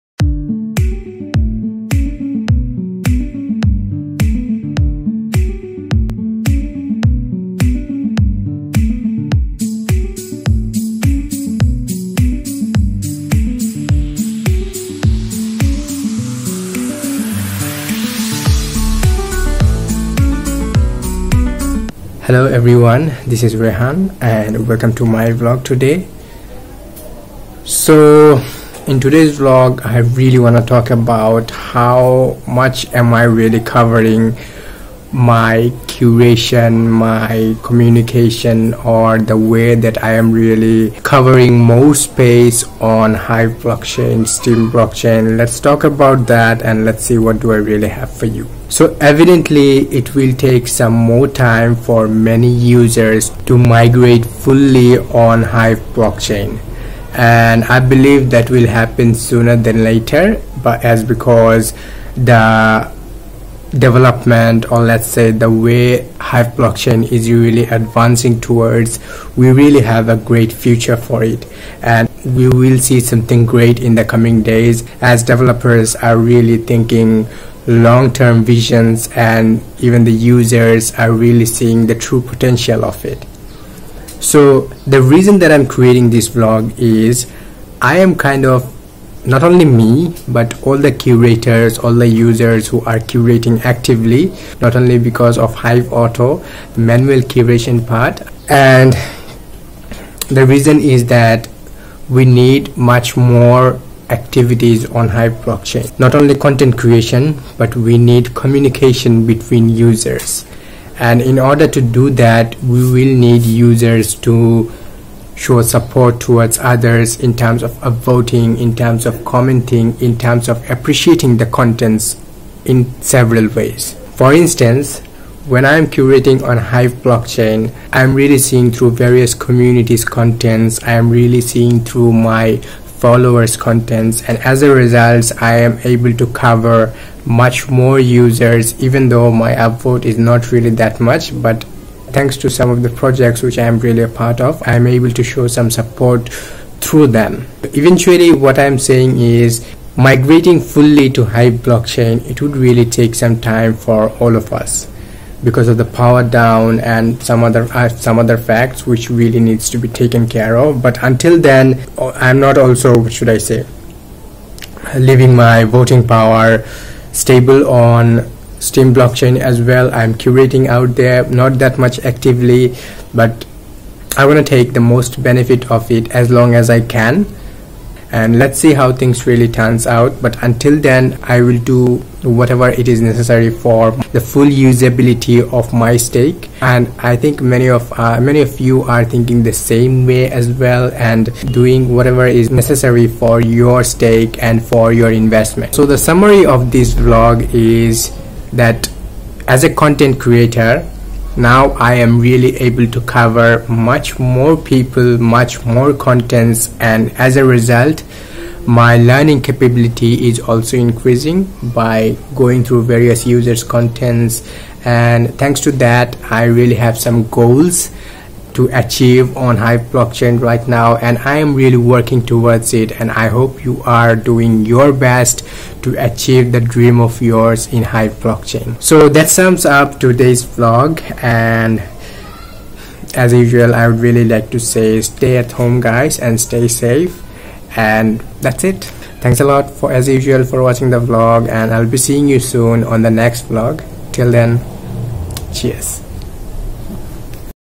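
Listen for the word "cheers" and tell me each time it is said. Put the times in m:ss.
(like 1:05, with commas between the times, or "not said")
4:05.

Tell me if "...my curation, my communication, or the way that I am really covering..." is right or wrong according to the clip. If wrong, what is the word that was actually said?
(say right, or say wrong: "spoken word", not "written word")
right.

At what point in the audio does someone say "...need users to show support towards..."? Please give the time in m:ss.
1:53.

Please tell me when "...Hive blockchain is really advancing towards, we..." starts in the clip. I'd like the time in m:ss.
1:06.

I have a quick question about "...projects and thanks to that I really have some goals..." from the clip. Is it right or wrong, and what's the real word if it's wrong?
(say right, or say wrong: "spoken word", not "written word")
wrong: "contents", not "projects".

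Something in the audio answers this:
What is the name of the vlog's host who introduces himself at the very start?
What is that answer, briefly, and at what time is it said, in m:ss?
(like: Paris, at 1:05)
Rehan, at 0:23.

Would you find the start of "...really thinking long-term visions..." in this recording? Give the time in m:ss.
1:16.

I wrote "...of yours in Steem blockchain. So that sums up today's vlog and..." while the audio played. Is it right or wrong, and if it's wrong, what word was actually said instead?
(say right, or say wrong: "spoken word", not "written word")
wrong: "Hive", not "Steem".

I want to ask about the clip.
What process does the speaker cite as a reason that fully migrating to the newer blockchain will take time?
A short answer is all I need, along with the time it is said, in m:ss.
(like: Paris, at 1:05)
power down, at 2:35.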